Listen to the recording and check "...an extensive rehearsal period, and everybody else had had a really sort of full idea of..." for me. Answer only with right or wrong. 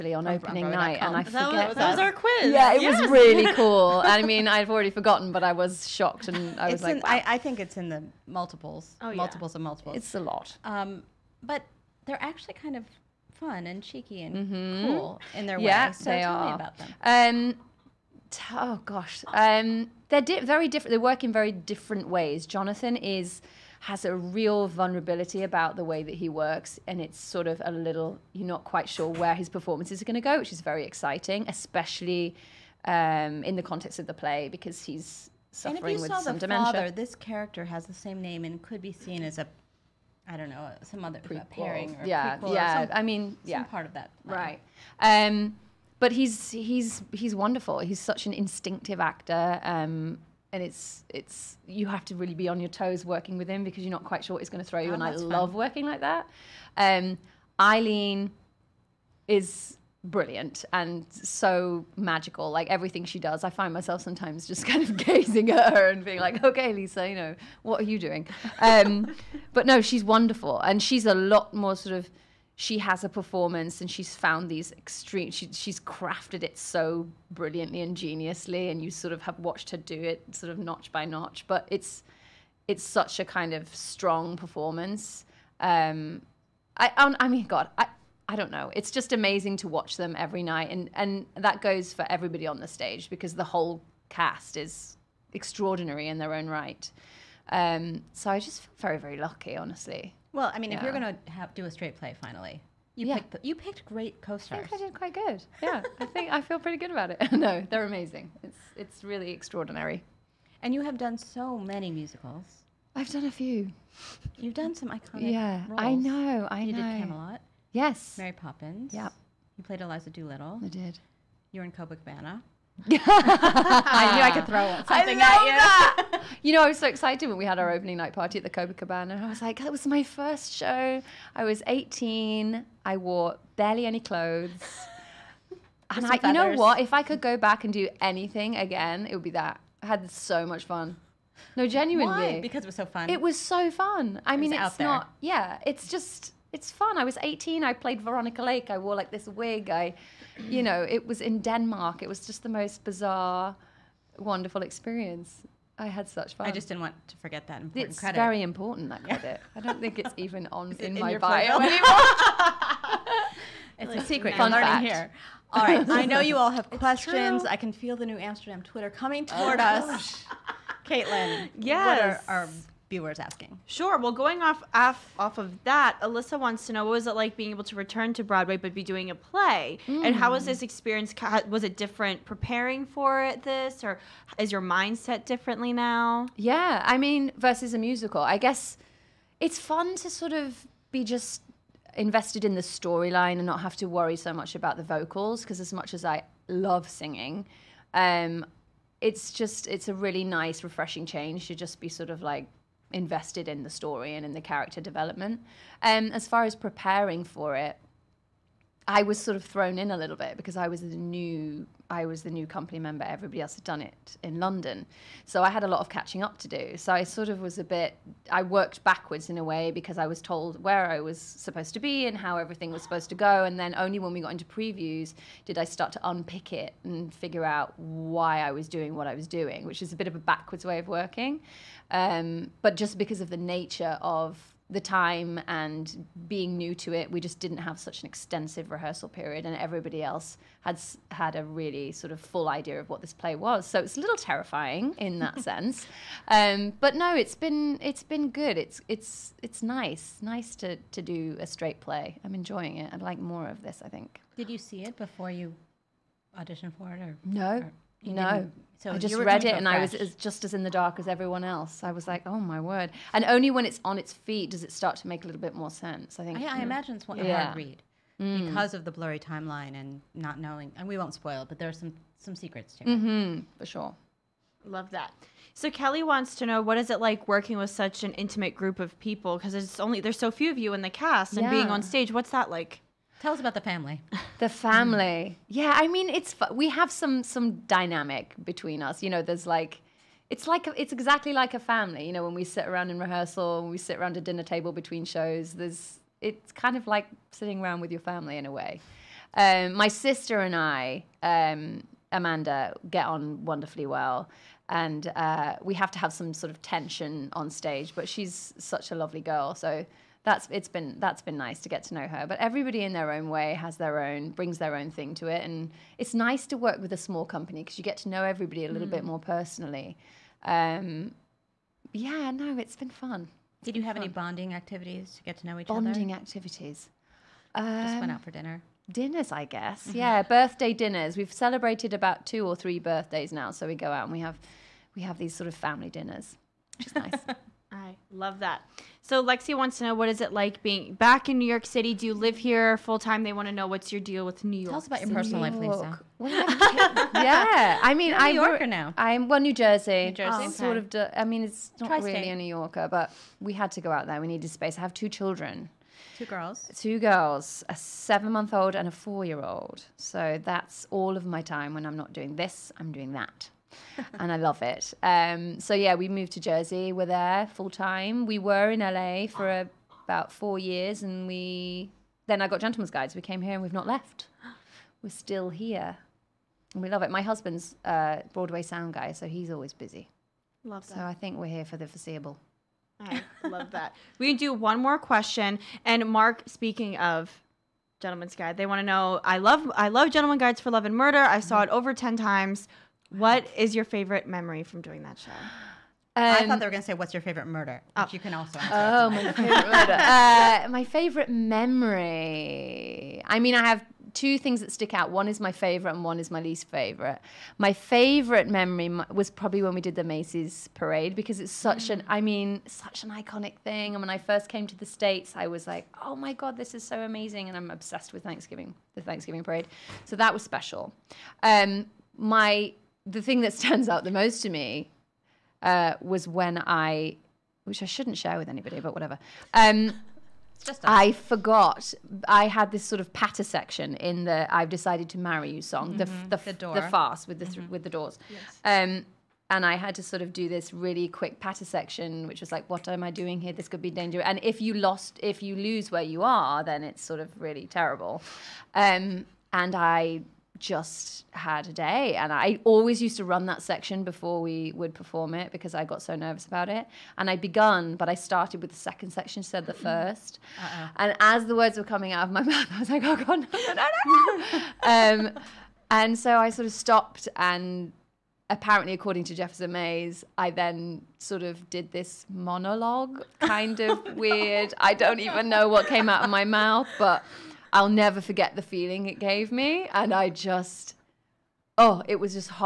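right.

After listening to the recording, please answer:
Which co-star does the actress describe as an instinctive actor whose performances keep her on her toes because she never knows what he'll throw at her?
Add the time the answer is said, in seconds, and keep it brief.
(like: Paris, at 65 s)
Jonathan, at 22 s.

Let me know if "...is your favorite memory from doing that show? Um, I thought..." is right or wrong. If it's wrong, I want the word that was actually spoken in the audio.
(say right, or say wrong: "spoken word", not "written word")
right.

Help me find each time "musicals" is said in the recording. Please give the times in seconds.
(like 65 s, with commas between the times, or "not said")
111 s, 187 s.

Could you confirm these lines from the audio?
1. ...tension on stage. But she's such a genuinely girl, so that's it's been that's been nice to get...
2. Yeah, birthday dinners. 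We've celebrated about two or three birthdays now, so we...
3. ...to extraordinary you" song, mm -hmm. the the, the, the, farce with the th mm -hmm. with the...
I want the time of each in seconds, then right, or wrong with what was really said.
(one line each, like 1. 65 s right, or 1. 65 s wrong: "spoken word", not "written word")
1. 306 s wrong: "lovely", not "genuinely"
2. 329 s right
3. 435 s wrong: "marry", not "extraordinary".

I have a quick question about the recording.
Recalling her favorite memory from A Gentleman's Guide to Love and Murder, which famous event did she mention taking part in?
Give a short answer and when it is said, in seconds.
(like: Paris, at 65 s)
Macy's parade, at 410 s.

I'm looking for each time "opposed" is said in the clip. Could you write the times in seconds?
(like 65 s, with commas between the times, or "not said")
not said.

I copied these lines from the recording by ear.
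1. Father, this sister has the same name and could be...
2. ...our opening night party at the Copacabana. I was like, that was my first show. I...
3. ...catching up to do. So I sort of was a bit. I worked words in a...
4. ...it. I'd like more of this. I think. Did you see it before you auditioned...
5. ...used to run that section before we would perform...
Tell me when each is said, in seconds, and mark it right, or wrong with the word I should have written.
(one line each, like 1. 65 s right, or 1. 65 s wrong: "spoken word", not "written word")
1. 36 s wrong: "character", not "sister"
2. 127 s right
3. 215 s wrong: "backwards", not "words"
4. 252 s right
5. 452 s right.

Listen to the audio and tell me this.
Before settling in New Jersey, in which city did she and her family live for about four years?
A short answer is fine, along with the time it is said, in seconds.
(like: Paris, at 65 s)
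LA, at 368 s.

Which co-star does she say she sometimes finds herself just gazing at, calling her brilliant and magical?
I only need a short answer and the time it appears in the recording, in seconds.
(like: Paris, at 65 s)
Eileen, at 57 s.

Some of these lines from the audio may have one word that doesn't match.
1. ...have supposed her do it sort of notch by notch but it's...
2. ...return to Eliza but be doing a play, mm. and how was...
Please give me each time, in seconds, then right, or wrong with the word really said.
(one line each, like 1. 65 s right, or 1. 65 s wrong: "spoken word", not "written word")
1. 79 s wrong: "watched", not "supposed"
2. 177 s wrong: "Broadway", not "Eliza".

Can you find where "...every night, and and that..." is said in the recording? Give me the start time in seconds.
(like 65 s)
90 s.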